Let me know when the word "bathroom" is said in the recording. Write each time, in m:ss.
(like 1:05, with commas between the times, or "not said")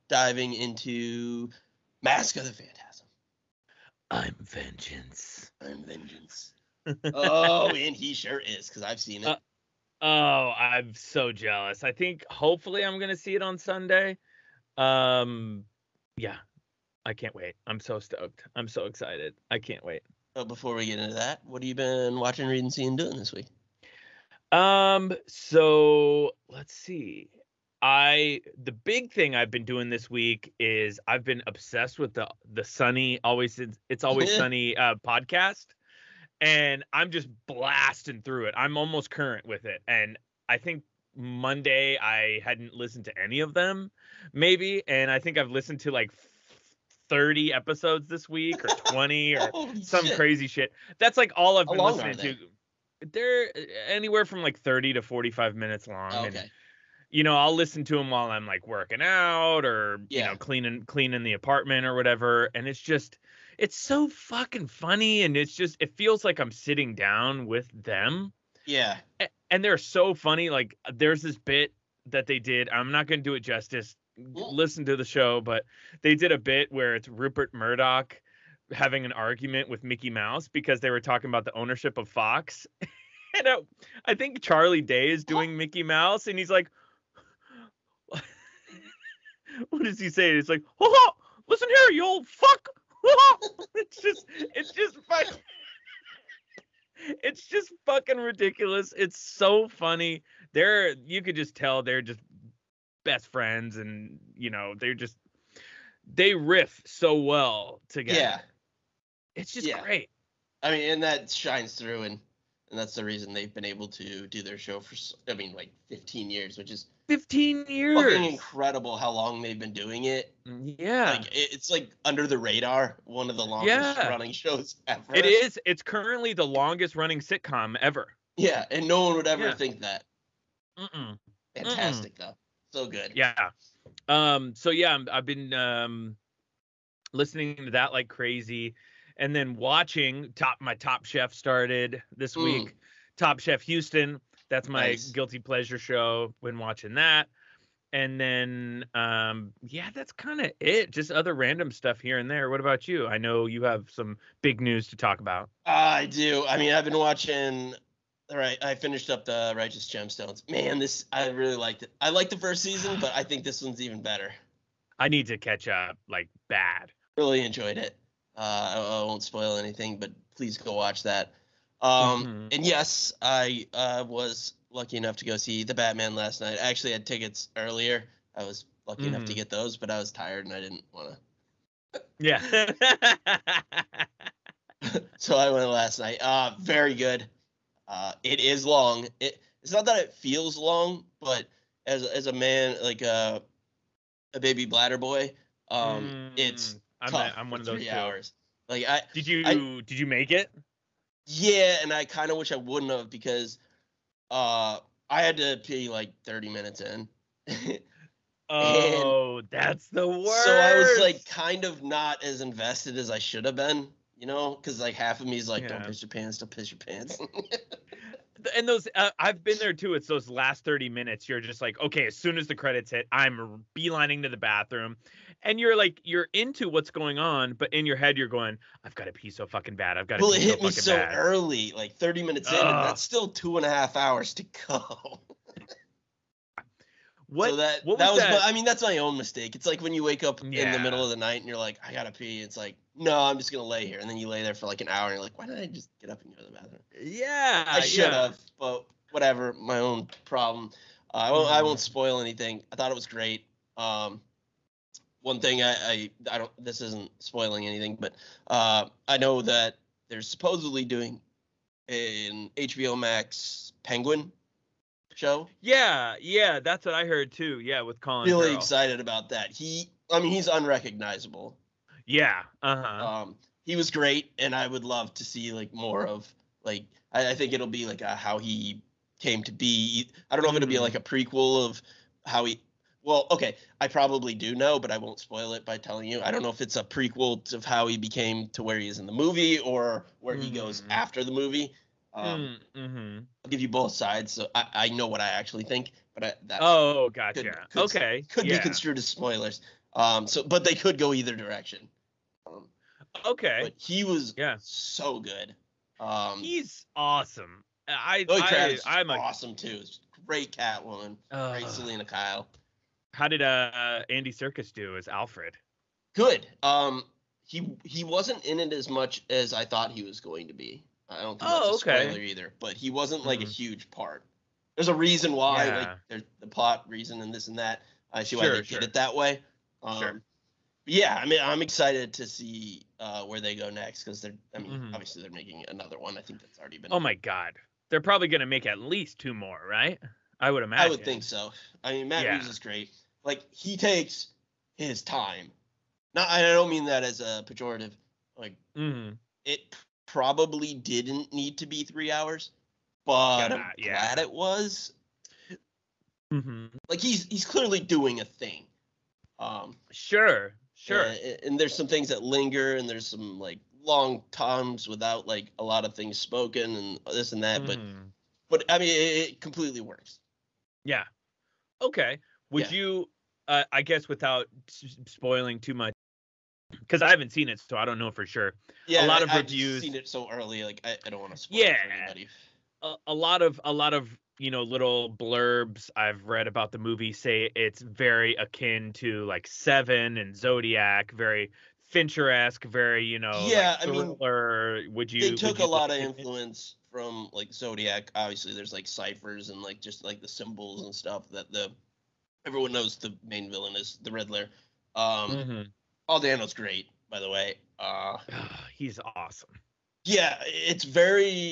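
3:44, 4:06.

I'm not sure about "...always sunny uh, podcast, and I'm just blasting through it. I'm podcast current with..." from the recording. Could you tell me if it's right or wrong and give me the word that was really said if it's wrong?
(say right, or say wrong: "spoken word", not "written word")
wrong: "almost", not "podcast".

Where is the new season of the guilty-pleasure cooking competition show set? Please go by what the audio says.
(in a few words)
Houston.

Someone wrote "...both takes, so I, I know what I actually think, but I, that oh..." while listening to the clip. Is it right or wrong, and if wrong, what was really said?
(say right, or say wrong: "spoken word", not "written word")
wrong: "sides", not "takes".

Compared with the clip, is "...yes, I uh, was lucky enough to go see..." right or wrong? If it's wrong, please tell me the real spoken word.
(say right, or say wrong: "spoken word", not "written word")
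right.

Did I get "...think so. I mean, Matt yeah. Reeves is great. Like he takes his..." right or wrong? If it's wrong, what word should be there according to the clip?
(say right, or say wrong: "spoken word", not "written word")
right.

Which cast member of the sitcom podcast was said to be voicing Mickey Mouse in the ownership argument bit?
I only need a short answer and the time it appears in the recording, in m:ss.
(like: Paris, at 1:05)
Charlie Day, at 1:24.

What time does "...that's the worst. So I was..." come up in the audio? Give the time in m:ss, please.
3:29.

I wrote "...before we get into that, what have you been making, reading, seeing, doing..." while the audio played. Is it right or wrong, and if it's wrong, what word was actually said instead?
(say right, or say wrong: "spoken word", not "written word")
wrong: "watching", not "making".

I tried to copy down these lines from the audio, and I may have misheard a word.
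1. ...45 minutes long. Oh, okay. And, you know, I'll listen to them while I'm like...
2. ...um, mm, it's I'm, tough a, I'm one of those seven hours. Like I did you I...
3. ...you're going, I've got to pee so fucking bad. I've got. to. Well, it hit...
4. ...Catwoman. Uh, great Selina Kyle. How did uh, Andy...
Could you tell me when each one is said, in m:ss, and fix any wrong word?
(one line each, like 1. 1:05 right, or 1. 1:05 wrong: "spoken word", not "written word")
1. 0:55 right
2. 3:15 wrong: "three", not "seven"
3. 3:48 right
4. 5:10 right.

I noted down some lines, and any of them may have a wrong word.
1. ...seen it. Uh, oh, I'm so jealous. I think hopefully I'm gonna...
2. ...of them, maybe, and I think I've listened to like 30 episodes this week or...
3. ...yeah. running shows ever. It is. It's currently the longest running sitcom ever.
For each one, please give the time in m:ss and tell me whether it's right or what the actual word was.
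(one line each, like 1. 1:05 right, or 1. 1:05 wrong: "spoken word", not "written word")
1. 0:08 right
2. 0:43 right
3. 2:03 right.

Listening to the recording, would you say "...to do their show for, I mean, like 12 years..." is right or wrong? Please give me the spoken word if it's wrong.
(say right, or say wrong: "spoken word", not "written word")
wrong: "15", not "12".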